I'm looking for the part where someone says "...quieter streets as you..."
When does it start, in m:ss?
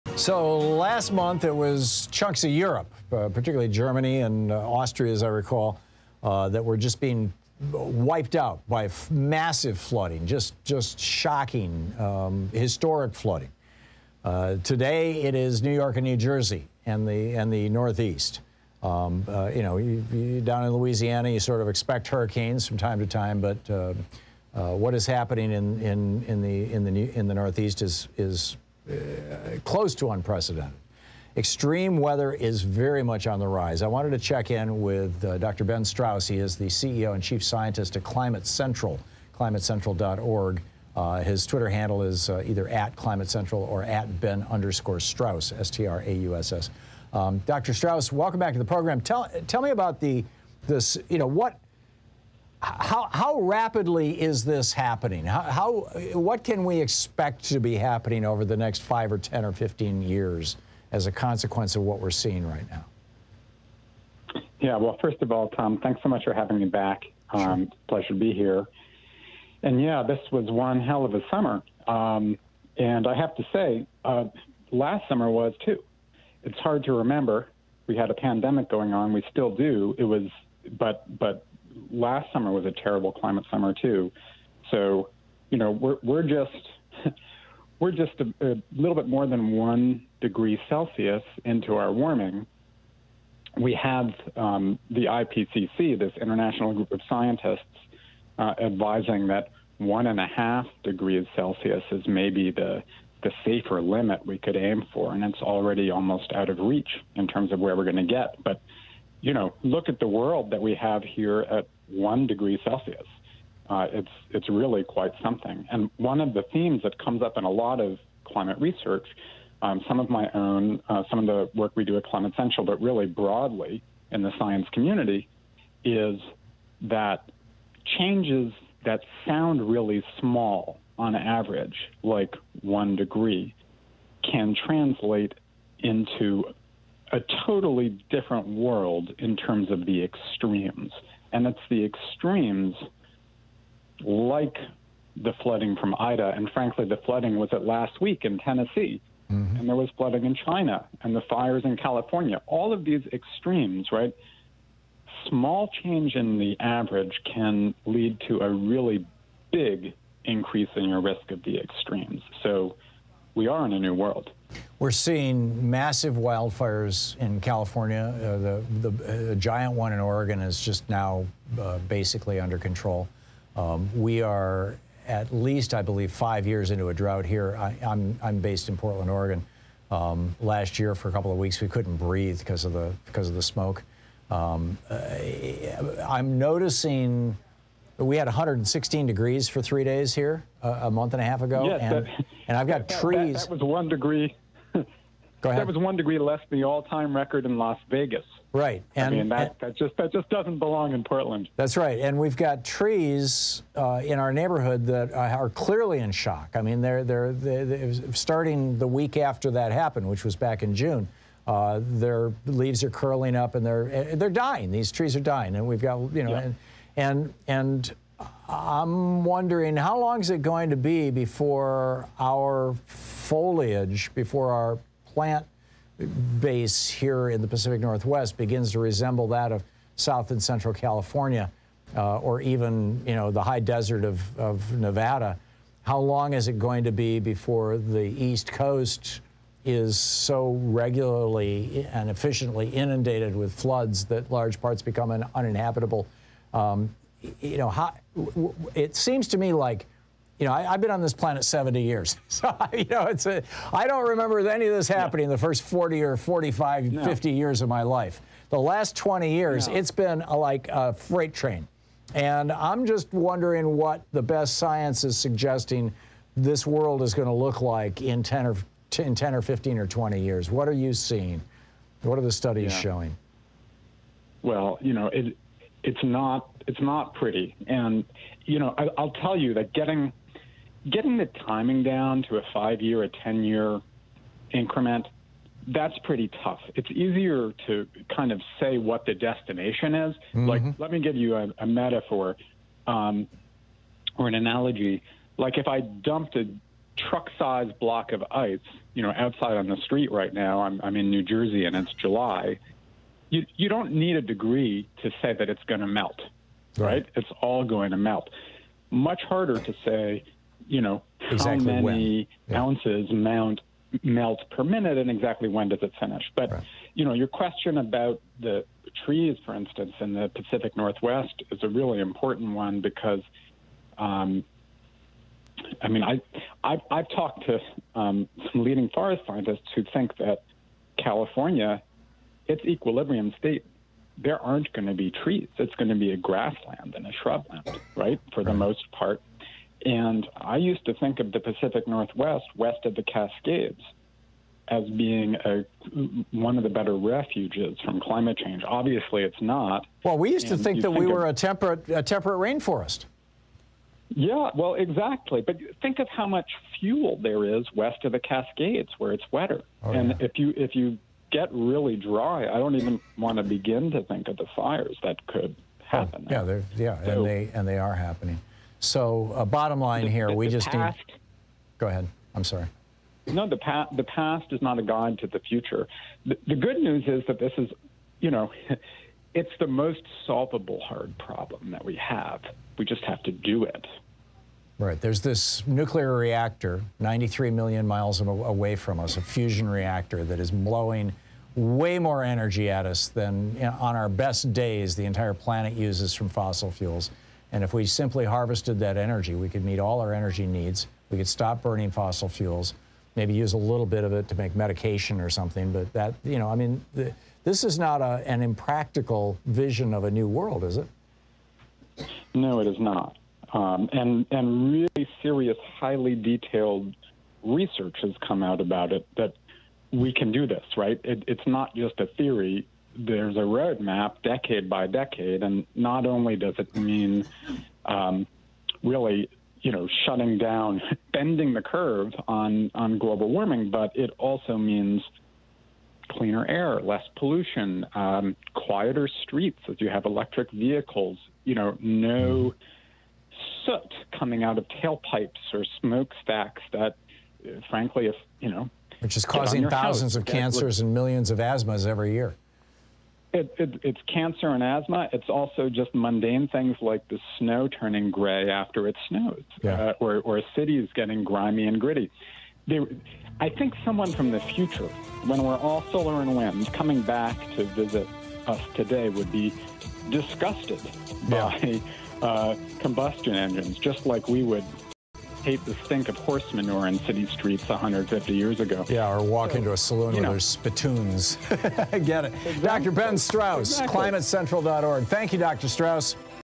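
7:18.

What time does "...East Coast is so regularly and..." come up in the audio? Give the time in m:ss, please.
3:58.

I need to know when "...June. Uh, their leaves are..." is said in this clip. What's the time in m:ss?
3:30.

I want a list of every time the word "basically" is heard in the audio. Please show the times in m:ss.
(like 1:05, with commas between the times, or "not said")
2:51.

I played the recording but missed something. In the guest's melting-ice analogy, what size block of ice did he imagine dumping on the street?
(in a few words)
Truck-sized.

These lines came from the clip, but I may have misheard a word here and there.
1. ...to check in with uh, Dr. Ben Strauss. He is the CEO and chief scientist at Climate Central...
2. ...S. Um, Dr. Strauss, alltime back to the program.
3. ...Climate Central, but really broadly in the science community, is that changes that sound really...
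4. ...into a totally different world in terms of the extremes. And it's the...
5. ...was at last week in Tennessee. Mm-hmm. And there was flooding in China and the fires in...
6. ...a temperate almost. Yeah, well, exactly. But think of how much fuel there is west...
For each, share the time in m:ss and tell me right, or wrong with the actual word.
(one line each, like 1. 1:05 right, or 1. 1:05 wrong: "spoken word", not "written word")
1. 0:34 right
2. 0:46 wrong: "welcome", not "alltime"
3. 2:02 right
4. 2:15 right
5. 2:27 right
6. 5:51 wrong: "rainforest", not "almost".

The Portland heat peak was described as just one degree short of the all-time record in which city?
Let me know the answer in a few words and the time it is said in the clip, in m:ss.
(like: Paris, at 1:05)
Las Vegas, at 3:17.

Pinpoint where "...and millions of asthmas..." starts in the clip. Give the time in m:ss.
7:30.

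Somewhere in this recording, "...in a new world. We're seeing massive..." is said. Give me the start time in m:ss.
2:43.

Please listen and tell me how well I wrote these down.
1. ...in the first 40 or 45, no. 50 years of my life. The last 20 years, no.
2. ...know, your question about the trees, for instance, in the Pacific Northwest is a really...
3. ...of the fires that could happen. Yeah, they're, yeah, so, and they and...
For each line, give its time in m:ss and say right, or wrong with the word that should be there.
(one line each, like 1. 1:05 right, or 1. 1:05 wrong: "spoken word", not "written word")
1. 4:15 right
2. 5:17 right
3. 6:04 right.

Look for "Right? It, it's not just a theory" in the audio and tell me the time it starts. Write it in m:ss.
7:00.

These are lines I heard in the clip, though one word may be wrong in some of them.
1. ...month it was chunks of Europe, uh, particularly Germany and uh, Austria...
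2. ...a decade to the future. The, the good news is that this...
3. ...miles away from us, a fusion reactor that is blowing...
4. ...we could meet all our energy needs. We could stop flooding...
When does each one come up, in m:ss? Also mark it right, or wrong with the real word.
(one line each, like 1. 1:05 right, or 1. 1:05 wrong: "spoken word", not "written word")
1. 0:01 right
2. 6:14 wrong: "guide", not "decade"
3. 6:27 right
4. 6:39 wrong: "burning", not "flooding".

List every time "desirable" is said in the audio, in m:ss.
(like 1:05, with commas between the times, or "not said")
not said.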